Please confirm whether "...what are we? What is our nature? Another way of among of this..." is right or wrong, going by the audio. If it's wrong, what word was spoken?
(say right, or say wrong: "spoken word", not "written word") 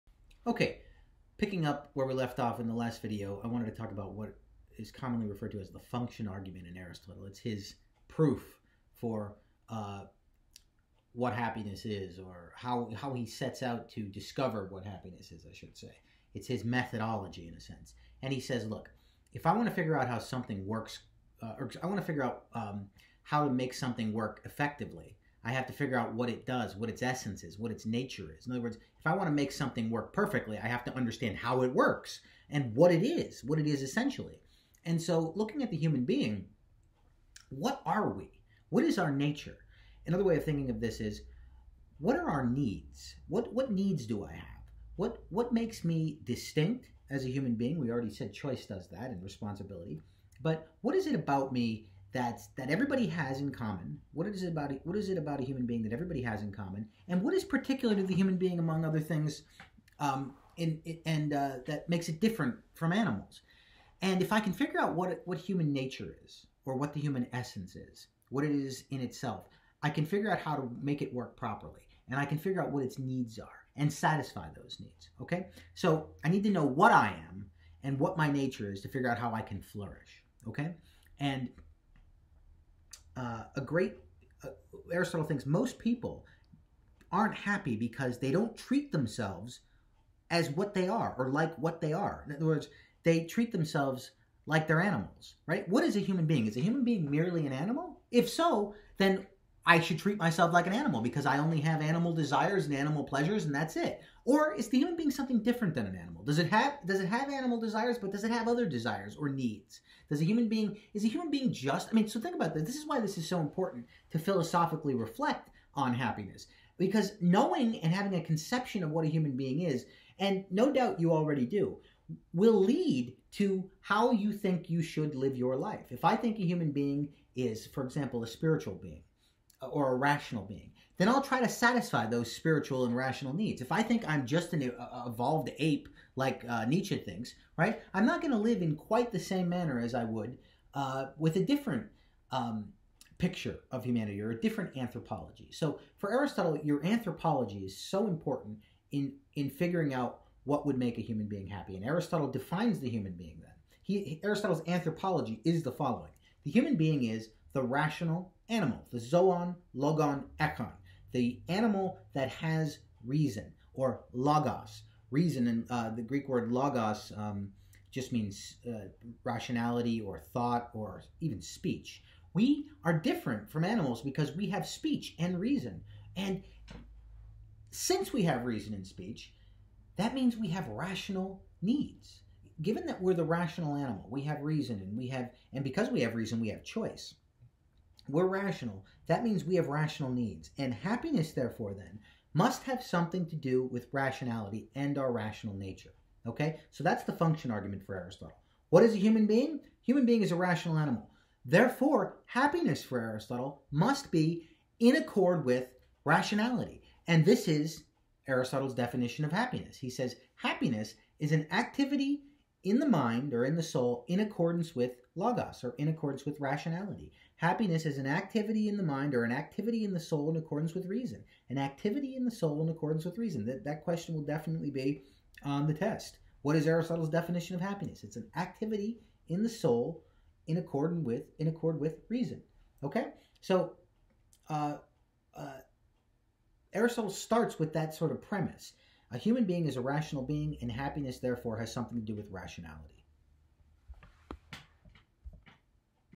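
wrong: "thinking", not "among".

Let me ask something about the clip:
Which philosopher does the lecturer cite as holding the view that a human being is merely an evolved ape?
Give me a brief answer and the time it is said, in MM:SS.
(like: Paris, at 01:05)
Nietzsche, at 02:16.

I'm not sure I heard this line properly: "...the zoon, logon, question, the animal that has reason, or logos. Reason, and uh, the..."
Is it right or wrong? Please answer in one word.
wrong.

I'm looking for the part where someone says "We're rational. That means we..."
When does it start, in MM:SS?
03:08.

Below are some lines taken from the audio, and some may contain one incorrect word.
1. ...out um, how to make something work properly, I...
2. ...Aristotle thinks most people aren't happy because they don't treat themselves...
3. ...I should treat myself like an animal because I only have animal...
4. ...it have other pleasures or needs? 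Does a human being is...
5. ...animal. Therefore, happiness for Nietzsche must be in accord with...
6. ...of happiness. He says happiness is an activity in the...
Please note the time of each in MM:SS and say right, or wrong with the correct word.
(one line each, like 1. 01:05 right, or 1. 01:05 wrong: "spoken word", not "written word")
1. 00:22 wrong: "effectively", not "properly"
2. 01:24 right
3. 01:39 right
4. 01:48 wrong: "desires", not "pleasures"
5. 03:20 wrong: "Aristotle", not "Nietzsche"
6. 03:29 right.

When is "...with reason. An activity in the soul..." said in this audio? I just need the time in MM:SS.
03:40.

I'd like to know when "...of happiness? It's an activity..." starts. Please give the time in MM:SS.
03:47.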